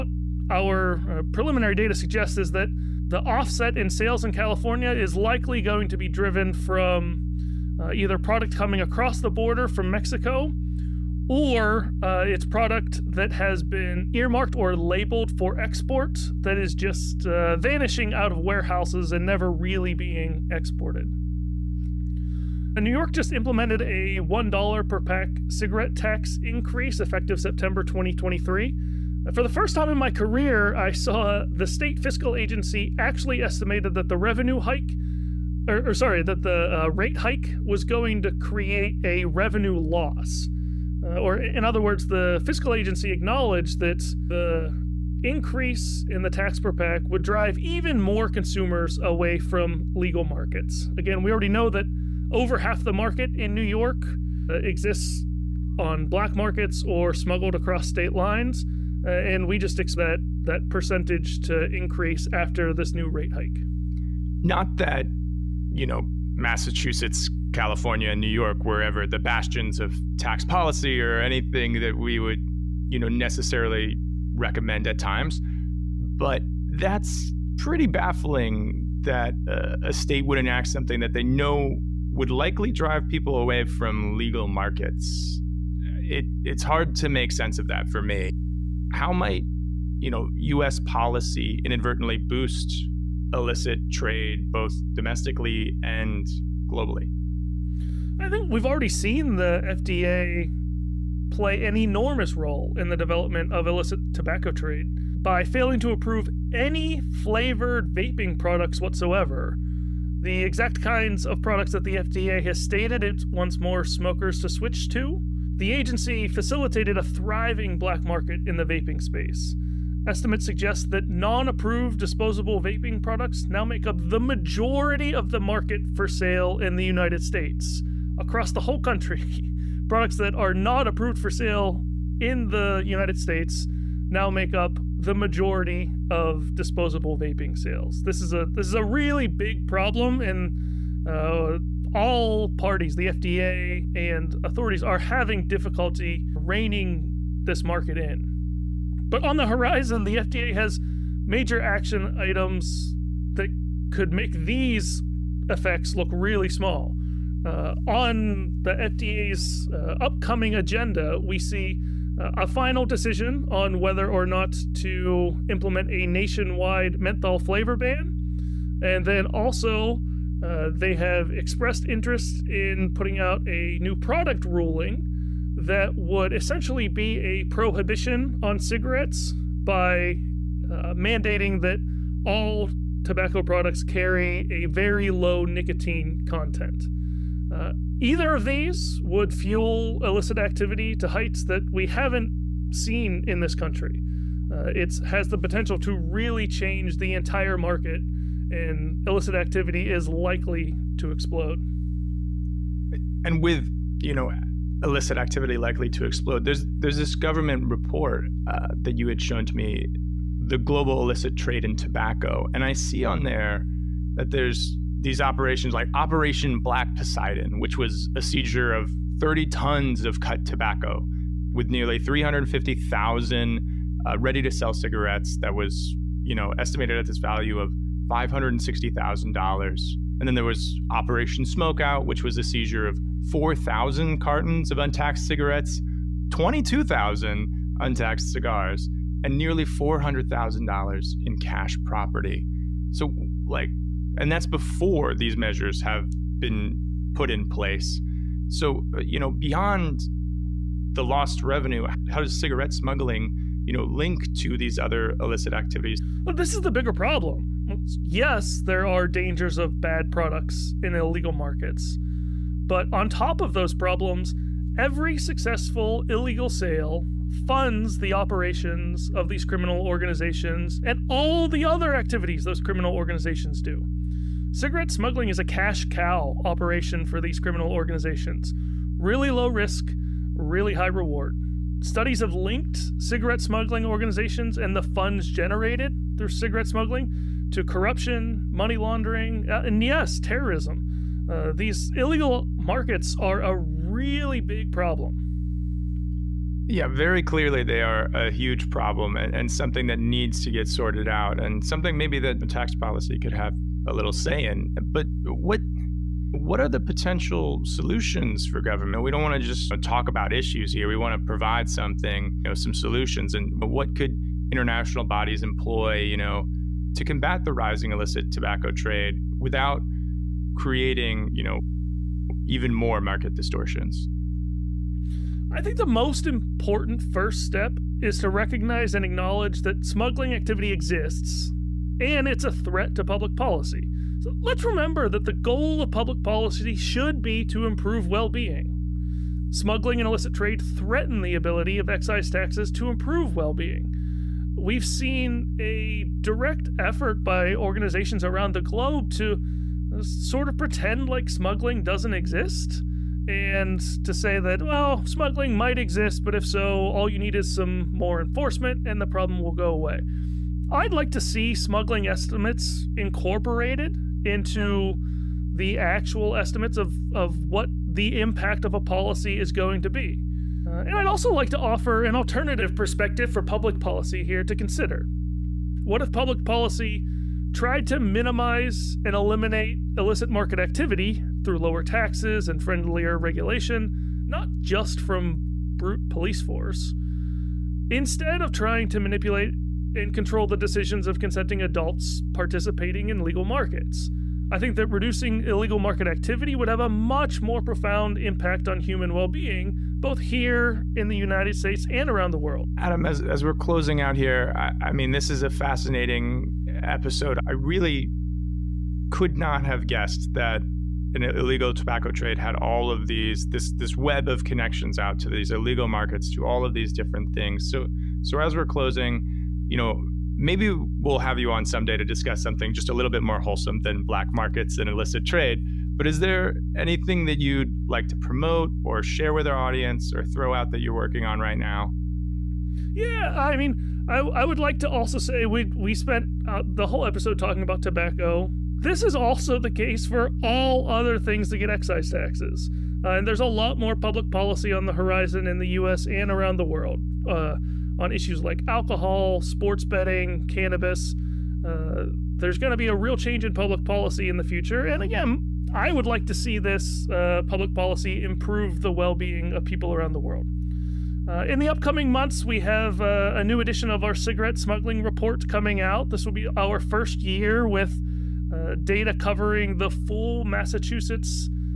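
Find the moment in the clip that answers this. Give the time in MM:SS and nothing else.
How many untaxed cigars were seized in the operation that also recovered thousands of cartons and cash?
03:56.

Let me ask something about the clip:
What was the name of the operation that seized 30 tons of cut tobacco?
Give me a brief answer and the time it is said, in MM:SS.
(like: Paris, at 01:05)
Operation Black Poseidon, at 03:35.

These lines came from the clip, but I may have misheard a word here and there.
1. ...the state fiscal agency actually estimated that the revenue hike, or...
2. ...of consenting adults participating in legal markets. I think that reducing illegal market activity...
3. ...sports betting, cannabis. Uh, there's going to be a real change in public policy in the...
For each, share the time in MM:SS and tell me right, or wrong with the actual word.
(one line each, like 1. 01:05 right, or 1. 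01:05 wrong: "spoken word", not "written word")
1. 00:31 right
2. 06:31 right
3. 07:29 right.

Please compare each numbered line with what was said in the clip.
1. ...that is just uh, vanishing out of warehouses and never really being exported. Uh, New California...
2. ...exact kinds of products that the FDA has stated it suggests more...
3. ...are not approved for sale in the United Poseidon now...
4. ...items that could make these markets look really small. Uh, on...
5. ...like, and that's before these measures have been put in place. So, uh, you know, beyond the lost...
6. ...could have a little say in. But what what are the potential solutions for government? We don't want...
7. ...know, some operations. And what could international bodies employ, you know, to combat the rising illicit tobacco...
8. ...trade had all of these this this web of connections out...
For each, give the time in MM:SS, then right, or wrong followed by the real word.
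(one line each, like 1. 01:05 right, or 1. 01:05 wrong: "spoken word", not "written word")
1. 00:16 wrong: "York", not "California"
2. 01:50 wrong: "wants", not "suggests"
3. 02:10 wrong: "States", not "Poseidon"
4. 02:32 wrong: "effects", not "markets"
5. 04:03 right
6. 05:03 right
7. 05:12 wrong: "solutions", not "operations"
8. 06:52 right.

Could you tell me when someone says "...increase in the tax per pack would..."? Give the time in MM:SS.
00:45.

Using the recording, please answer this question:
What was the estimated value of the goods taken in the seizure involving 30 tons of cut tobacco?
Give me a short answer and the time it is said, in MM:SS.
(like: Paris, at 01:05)
$560,000, at 03:48.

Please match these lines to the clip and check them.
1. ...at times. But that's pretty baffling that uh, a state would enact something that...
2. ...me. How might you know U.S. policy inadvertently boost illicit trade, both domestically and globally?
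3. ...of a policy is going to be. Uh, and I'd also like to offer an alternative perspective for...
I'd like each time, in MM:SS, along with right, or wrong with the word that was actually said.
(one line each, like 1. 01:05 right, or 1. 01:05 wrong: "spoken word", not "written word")
1. 01:14 right
2. 01:28 right
3. 06:08 right.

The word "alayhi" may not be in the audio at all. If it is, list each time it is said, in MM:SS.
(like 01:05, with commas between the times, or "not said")
not said.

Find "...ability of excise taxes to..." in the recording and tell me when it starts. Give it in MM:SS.
05:41.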